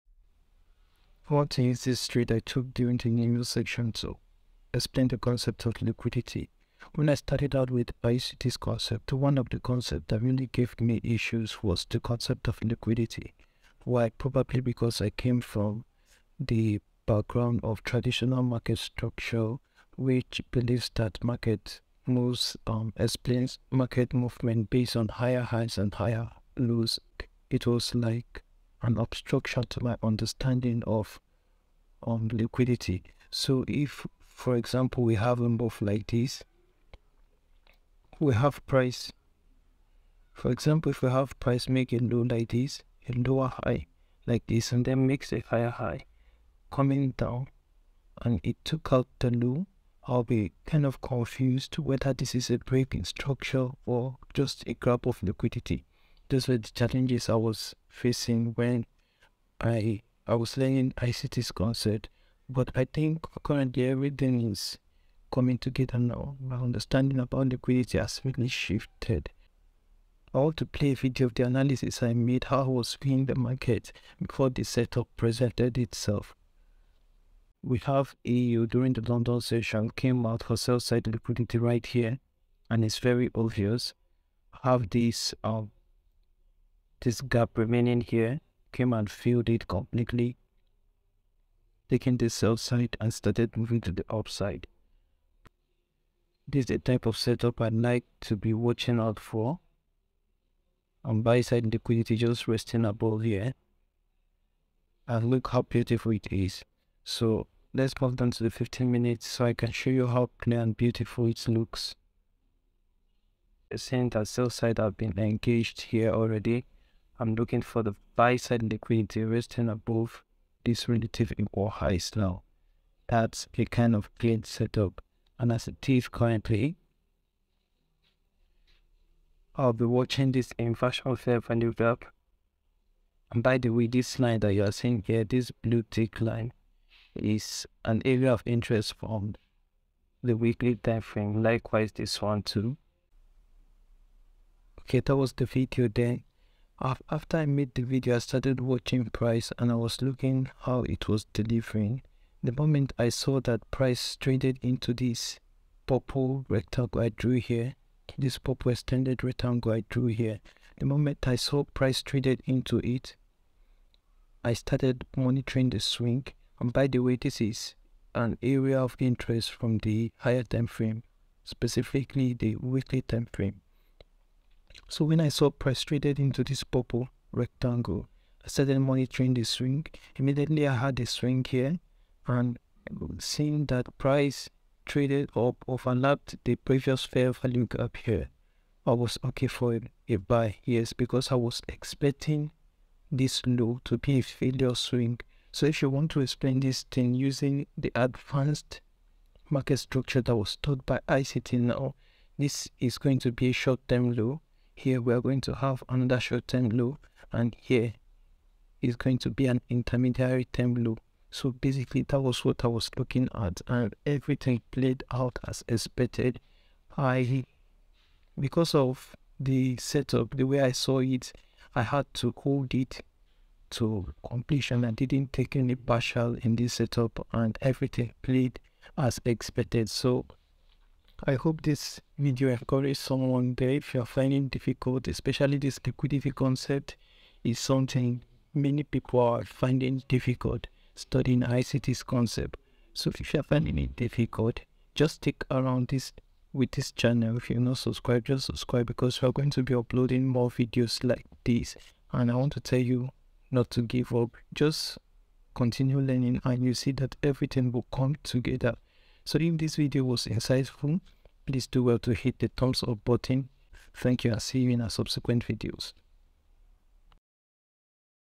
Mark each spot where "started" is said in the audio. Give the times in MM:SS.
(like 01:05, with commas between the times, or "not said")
00:07, 01:33, 02:28, 02:44, 02:58.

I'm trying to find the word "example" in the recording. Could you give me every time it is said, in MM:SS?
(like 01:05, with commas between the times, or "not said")
00:34, 00:40.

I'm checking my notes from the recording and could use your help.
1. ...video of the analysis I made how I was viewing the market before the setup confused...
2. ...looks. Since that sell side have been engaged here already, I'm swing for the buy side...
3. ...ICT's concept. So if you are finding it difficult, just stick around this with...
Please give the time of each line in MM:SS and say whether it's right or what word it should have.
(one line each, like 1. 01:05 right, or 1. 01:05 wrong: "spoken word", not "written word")
1. 01:10 wrong: "presented", not "confused"
2. 01:51 wrong: "looking", not "swing"
3. 04:01 right.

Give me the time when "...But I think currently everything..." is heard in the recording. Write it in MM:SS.
01:02.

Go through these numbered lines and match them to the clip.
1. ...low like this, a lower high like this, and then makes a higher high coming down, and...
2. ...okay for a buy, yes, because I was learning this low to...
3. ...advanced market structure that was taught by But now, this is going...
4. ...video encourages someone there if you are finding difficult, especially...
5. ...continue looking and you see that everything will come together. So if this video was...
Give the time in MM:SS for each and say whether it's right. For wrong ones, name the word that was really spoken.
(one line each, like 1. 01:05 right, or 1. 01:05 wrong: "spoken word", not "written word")
1. 00:41 right
2. 03:09 wrong: "expecting", not "learning"
3. 03:17 wrong: "ICT", not "But"
4. 03:52 right
5. 04:15 wrong: "learning", not "looking".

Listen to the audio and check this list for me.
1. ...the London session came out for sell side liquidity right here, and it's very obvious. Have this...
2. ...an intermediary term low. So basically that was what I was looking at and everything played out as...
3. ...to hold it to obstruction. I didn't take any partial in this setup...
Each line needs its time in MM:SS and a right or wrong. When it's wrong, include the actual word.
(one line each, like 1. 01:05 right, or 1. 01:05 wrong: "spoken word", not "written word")
1. 01:18 right
2. 03:29 right
3. 03:42 wrong: "completion", not "obstruction".